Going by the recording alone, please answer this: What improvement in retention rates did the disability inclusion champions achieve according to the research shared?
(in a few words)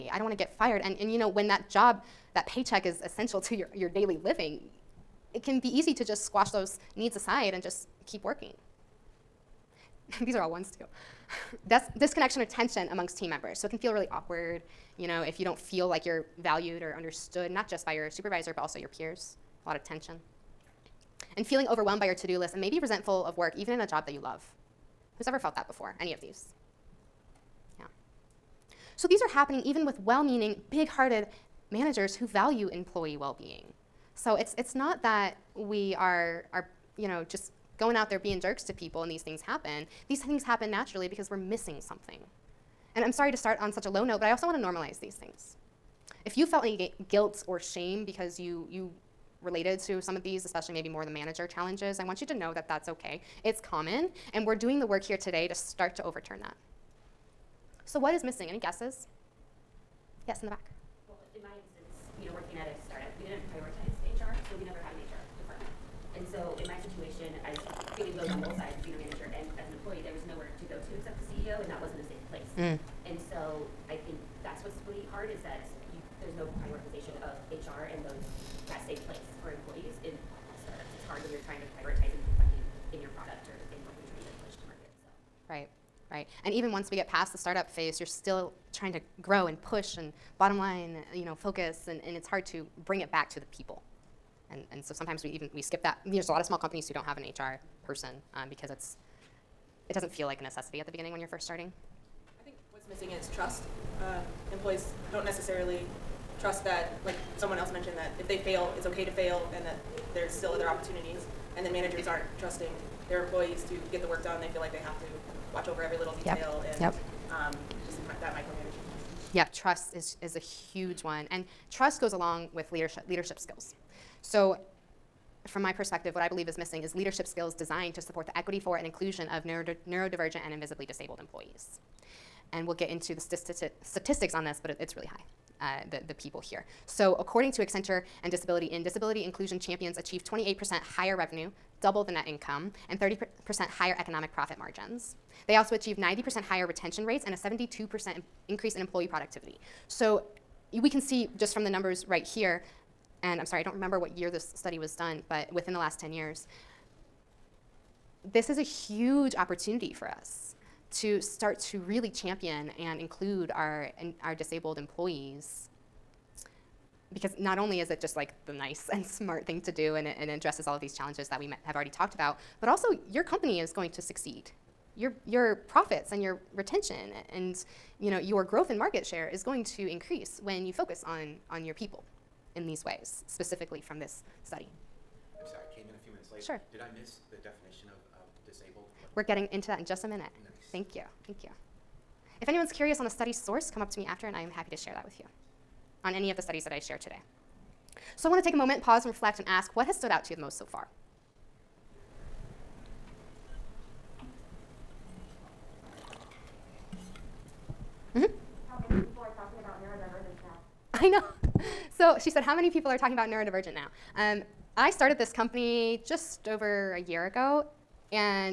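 90% higher.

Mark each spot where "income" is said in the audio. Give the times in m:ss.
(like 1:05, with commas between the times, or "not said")
2:22.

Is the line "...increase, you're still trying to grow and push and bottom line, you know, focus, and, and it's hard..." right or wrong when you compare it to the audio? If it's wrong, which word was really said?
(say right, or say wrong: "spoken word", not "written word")
wrong: "phase", not "increase".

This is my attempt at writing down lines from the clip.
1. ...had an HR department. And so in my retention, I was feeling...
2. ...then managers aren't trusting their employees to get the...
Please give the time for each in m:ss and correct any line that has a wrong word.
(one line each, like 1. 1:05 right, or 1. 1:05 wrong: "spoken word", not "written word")
1. 1:04 wrong: "situation", not "retention"
2. 1:51 right.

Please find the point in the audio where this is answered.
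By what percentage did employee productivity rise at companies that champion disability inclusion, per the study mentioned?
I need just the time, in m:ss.
2:27.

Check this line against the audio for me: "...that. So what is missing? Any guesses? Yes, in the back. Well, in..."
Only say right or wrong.
right.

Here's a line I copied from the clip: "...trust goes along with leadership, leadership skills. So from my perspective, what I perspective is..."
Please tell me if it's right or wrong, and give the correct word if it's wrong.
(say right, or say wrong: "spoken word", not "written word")
wrong: "believe", not "perspective".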